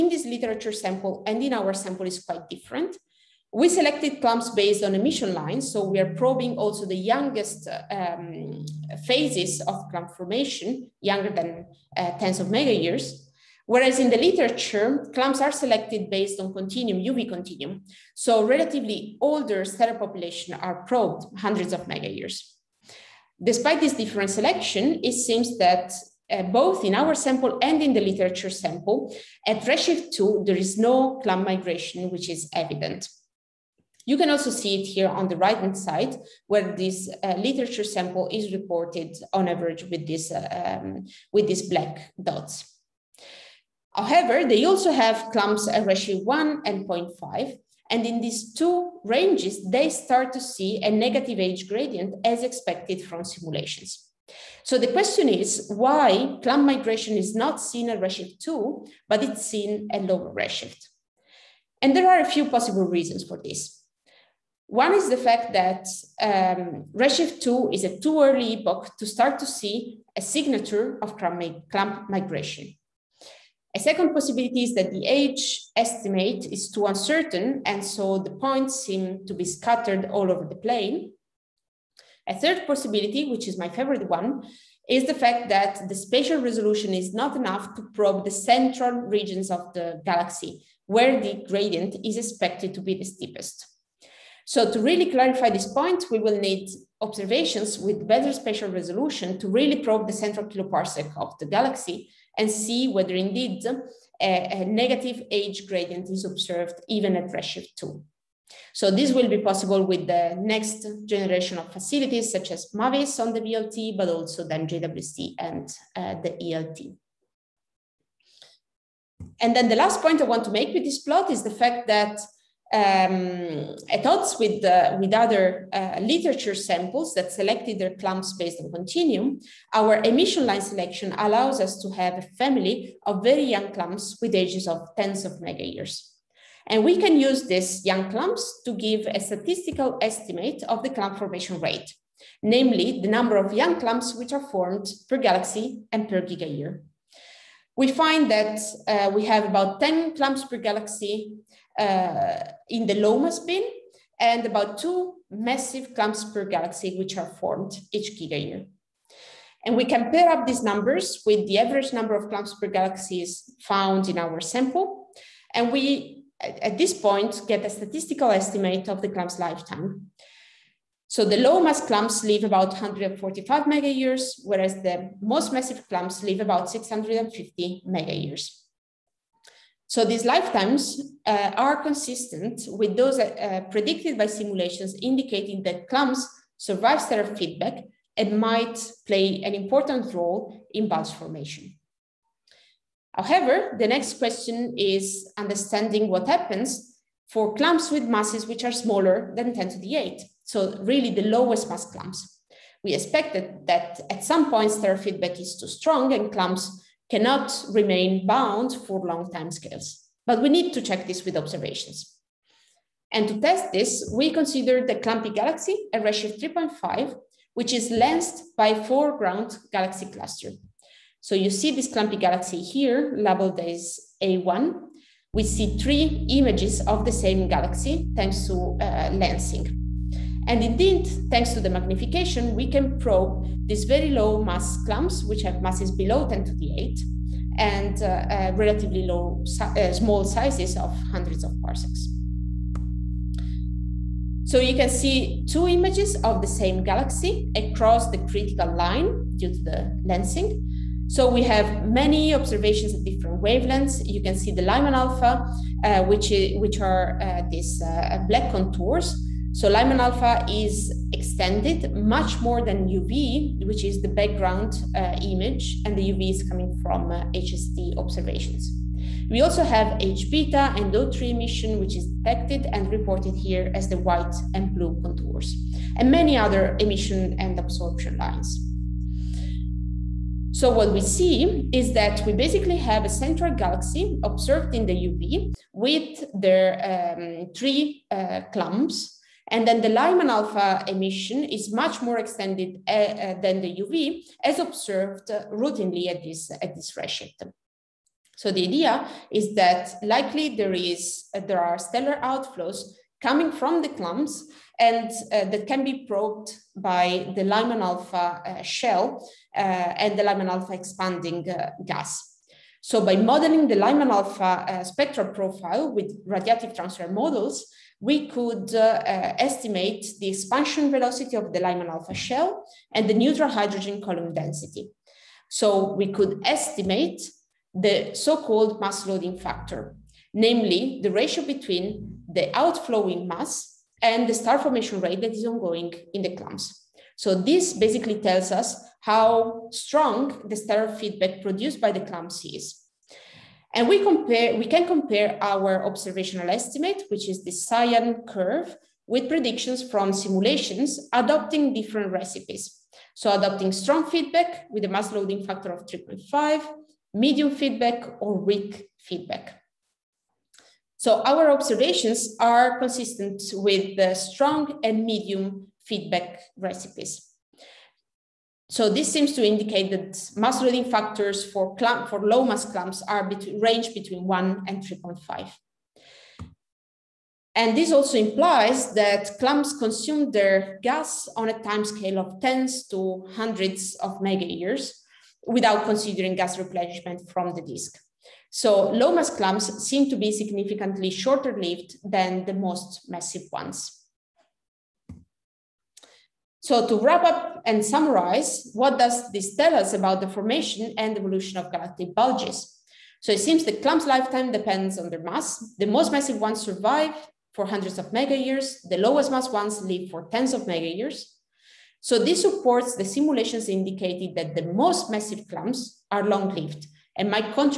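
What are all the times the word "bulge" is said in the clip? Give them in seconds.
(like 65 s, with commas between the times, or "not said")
190 s, 402 s.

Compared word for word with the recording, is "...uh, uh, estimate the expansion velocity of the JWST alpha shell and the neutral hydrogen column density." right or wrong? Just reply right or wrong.
wrong.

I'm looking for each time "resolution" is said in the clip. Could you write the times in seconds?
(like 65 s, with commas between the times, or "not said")
86 s, 98 s.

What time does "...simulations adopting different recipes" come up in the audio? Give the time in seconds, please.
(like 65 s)
350 s.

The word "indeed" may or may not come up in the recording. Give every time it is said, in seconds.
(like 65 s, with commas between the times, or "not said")
103 s, 230 s.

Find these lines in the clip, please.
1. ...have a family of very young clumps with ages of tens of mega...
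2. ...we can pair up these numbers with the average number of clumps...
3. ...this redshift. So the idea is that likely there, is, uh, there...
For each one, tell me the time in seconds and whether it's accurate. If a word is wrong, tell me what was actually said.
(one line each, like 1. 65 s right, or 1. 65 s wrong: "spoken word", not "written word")
1. 131 s right
2. 159 s right
3. 296 s right.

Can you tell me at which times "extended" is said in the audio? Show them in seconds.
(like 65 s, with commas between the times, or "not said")
261 s, 292 s.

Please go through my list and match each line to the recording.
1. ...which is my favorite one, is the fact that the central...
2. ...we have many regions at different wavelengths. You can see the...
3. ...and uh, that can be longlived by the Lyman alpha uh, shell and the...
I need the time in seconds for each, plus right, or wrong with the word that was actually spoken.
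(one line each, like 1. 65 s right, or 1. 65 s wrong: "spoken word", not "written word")
1. 83 s wrong: "spatial", not "central"
2. 251 s wrong: "observations", not "regions"
3. 304 s wrong: "probed", not "longlived".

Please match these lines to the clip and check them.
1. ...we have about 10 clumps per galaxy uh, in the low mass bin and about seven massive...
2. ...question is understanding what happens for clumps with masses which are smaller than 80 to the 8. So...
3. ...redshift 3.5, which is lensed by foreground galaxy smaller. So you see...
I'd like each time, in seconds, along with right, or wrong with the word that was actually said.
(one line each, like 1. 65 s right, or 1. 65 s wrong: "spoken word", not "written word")
1. 149 s wrong: "two", not "seven"
2. 194 s wrong: "10", not "80"
3. 216 s wrong: "cluster", not "smaller".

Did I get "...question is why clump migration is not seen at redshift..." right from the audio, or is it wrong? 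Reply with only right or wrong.
right.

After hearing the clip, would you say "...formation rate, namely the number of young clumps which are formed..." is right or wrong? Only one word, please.
right.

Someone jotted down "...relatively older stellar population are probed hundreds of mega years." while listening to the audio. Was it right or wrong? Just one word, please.
right.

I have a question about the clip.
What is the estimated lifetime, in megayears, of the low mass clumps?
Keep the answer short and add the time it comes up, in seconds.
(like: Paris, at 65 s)
145, at 172 s.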